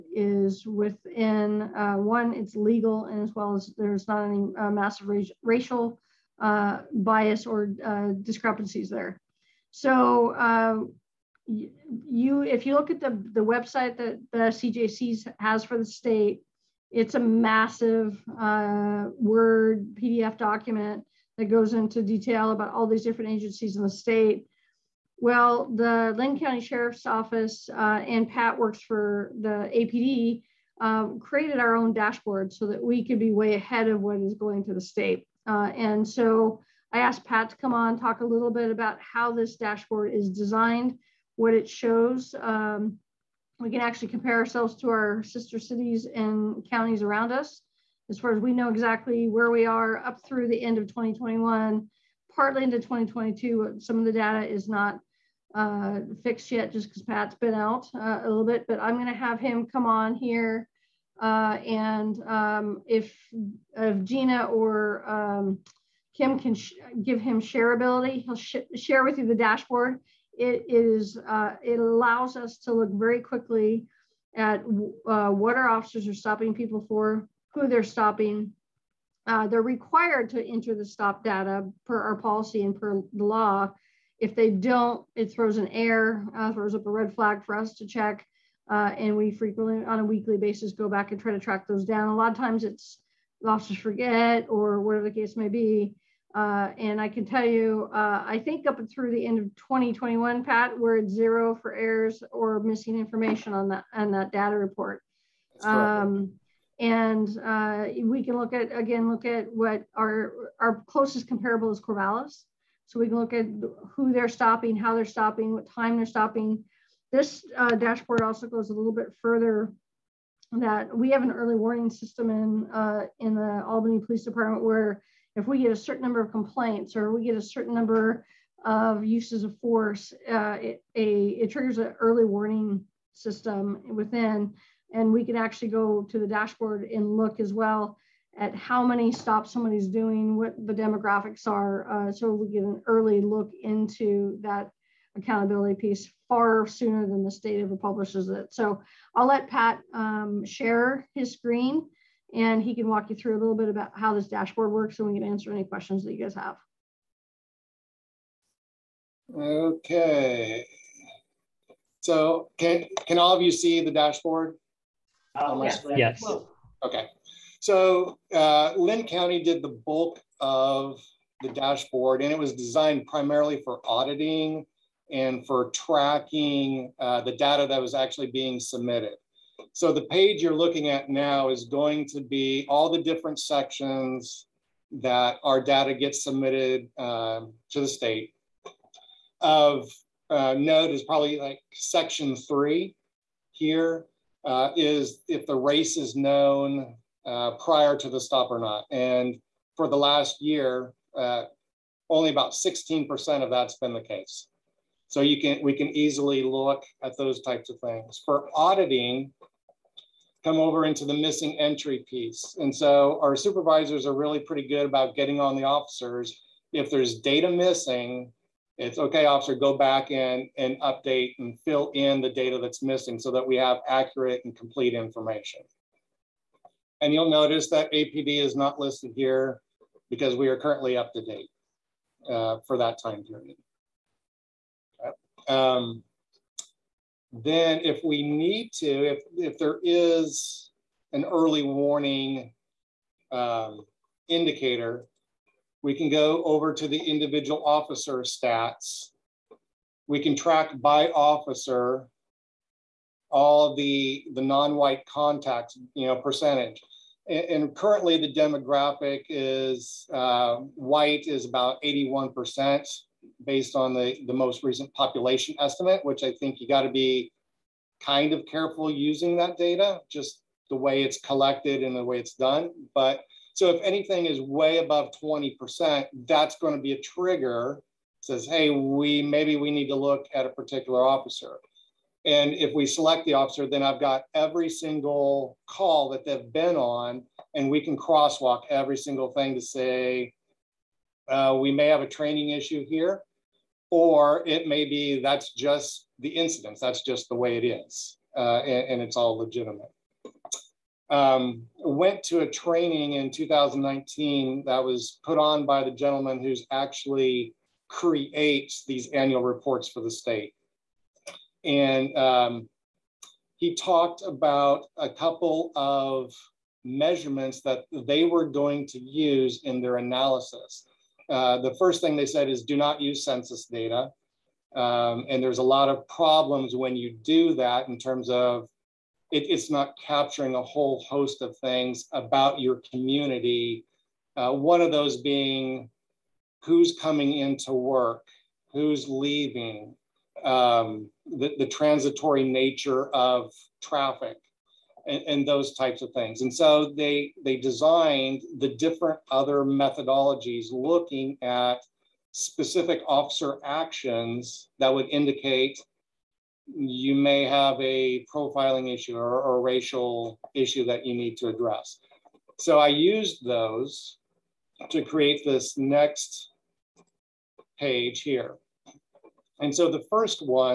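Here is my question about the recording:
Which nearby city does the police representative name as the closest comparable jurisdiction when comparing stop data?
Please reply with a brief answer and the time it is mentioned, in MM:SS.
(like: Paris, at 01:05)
Corvallis, at 01:51.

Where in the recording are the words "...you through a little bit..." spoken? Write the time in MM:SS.
02:33.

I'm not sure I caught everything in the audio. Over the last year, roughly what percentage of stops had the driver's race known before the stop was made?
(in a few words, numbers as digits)
16%.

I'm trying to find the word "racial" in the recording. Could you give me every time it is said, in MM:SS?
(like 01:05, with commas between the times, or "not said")
00:05, 05:59.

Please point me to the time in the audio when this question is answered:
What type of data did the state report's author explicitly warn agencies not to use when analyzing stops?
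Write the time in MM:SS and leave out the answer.
05:23.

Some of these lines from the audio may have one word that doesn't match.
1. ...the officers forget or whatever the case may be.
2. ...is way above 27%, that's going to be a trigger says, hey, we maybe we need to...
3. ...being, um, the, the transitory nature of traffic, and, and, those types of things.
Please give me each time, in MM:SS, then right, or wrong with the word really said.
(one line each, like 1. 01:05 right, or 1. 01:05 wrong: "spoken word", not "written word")
1. 01:33 right
2. 04:34 wrong: "20", not "27"
3. 05:39 wrong: "leaving", not "being".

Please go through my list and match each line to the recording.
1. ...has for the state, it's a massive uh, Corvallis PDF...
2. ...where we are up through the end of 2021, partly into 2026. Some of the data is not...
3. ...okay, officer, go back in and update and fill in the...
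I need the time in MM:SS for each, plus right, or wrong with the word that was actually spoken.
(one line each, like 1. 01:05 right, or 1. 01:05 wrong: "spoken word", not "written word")
1. 00:15 wrong: "Word", not "Corvallis"
2. 00:49 wrong: "2022", not "2026"
3. 03:38 right.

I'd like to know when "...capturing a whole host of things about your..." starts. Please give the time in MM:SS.
05:30.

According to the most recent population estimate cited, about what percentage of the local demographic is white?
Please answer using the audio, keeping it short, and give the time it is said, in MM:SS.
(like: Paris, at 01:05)
81%, at 04:21.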